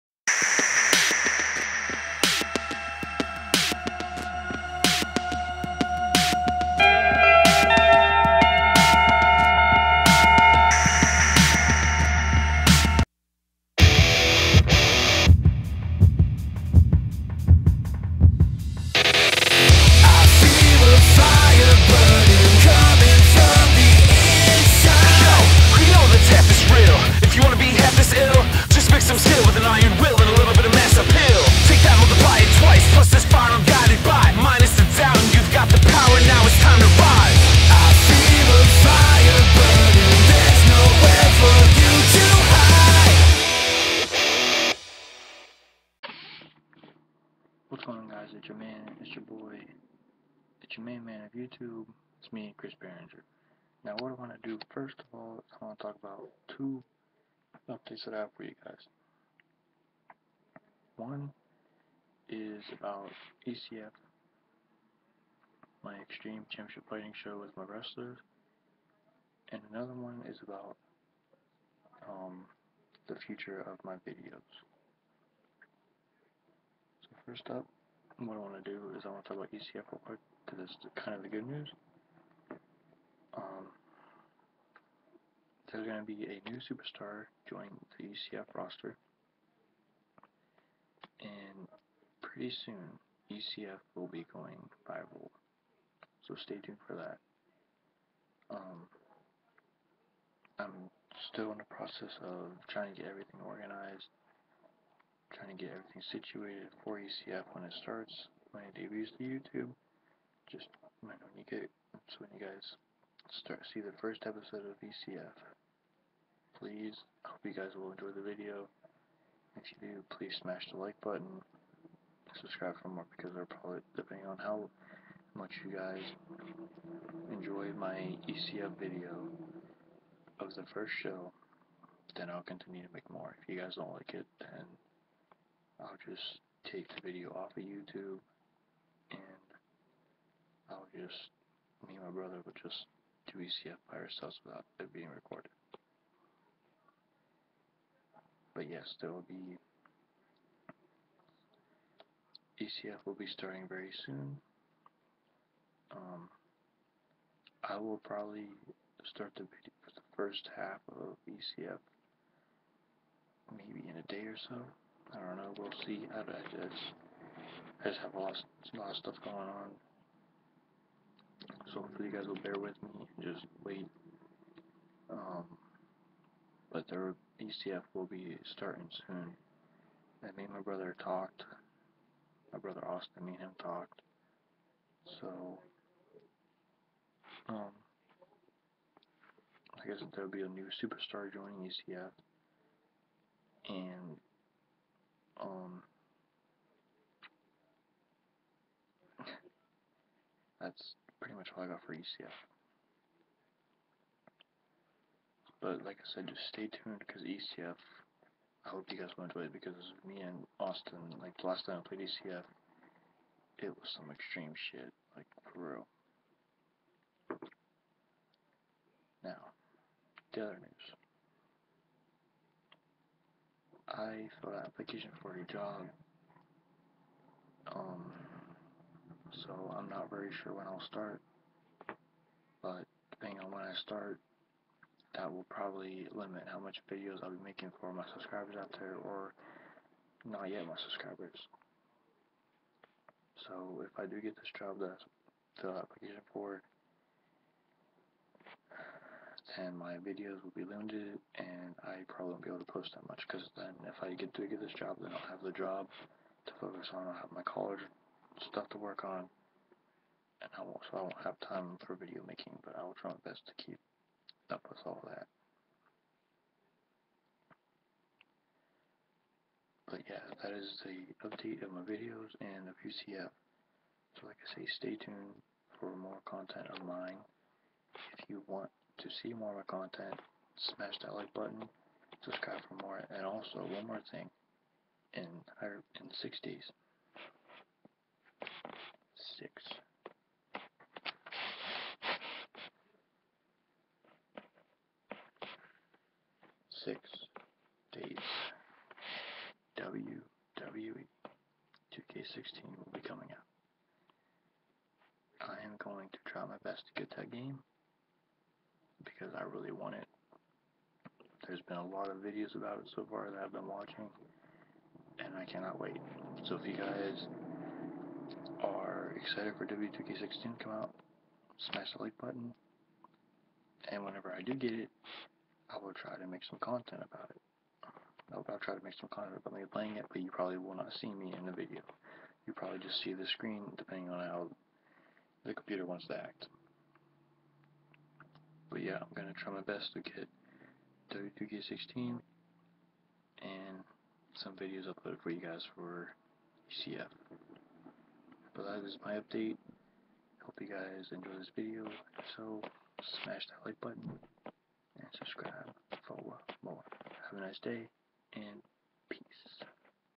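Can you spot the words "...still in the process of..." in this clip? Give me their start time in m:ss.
1:41.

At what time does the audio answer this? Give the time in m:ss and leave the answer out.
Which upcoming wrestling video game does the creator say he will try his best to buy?
4:59.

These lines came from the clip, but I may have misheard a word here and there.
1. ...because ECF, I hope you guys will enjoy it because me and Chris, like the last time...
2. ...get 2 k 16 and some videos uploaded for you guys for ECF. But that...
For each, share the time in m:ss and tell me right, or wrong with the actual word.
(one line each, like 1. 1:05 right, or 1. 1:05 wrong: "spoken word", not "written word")
1. 3:27 wrong: "Austin", not "Chris"
2. 5:40 right.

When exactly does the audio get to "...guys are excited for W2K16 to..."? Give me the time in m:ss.
5:16.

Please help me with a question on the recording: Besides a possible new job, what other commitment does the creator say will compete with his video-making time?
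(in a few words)
college.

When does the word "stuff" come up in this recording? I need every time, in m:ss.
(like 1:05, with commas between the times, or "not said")
2:48, 4:18.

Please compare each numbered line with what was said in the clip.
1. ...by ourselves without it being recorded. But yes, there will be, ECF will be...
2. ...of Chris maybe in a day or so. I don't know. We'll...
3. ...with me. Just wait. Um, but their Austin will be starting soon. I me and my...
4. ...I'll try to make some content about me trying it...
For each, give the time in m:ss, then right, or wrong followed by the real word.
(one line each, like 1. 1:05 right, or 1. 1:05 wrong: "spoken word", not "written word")
1. 2:23 right
2. 2:40 wrong: "ECF", not "Chris"
3. 2:52 wrong: "ECF", not "Austin"
4. 5:28 wrong: "playing", not "trying".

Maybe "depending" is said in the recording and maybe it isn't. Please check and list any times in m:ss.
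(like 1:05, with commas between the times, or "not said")
2:03, 3:53, 5:33.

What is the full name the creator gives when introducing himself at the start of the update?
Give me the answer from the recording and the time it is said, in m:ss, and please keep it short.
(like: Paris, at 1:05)
Chris Behringer, at 0:52.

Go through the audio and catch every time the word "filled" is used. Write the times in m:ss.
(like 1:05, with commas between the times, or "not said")
3:44, 4:05.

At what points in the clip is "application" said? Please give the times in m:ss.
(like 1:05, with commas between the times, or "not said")
3:44, 4:05.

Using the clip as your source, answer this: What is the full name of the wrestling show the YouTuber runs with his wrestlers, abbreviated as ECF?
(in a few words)
Extreme Championship Fighting.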